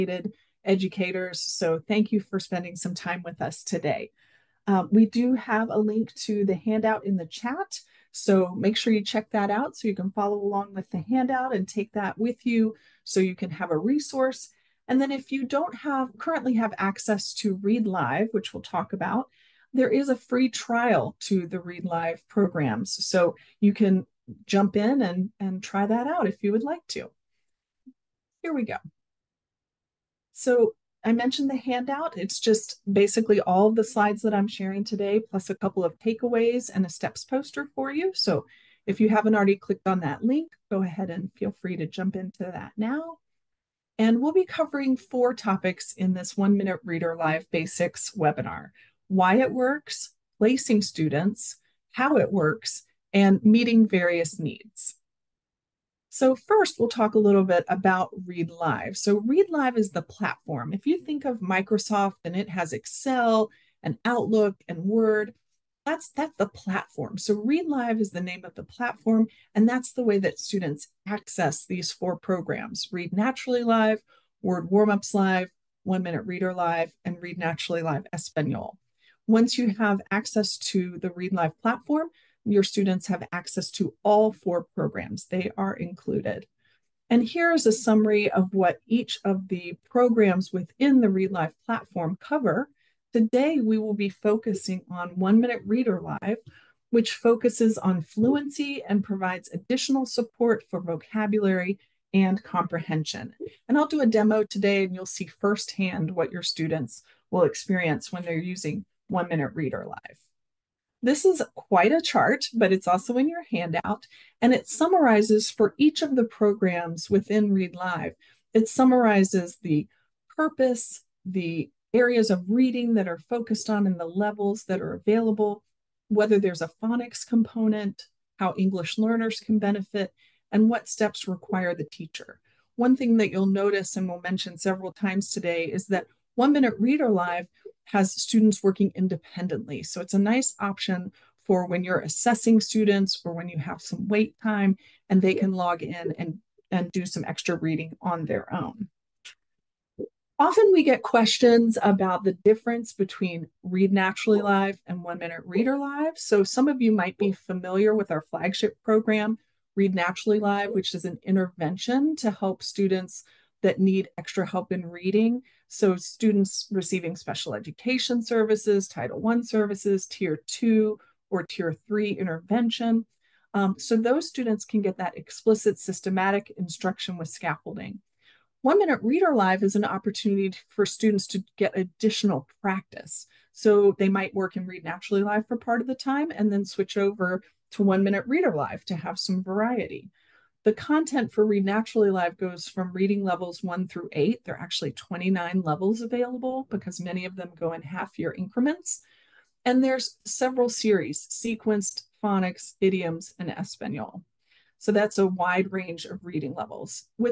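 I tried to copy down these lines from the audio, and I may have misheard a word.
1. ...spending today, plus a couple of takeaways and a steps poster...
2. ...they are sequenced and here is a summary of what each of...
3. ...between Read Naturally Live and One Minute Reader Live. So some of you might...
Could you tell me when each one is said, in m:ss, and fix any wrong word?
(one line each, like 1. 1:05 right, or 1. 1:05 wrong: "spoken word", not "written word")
1. 0:34 wrong: "sharing", not "spending"
2. 1:25 wrong: "included", not "sequenced"
3. 2:32 right.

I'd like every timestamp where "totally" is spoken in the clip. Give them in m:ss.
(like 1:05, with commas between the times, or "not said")
not said.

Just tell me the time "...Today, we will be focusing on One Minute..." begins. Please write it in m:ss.
1:33.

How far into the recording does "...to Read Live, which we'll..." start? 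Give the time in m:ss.
0:17.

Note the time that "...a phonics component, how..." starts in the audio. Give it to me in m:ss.
2:06.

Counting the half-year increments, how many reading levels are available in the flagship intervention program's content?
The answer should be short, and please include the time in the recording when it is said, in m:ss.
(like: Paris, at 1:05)
29, at 3:14.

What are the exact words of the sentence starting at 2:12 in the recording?
One thing that you'll notice and we'll mention several times today is that One Minute Reader Live has students working independently.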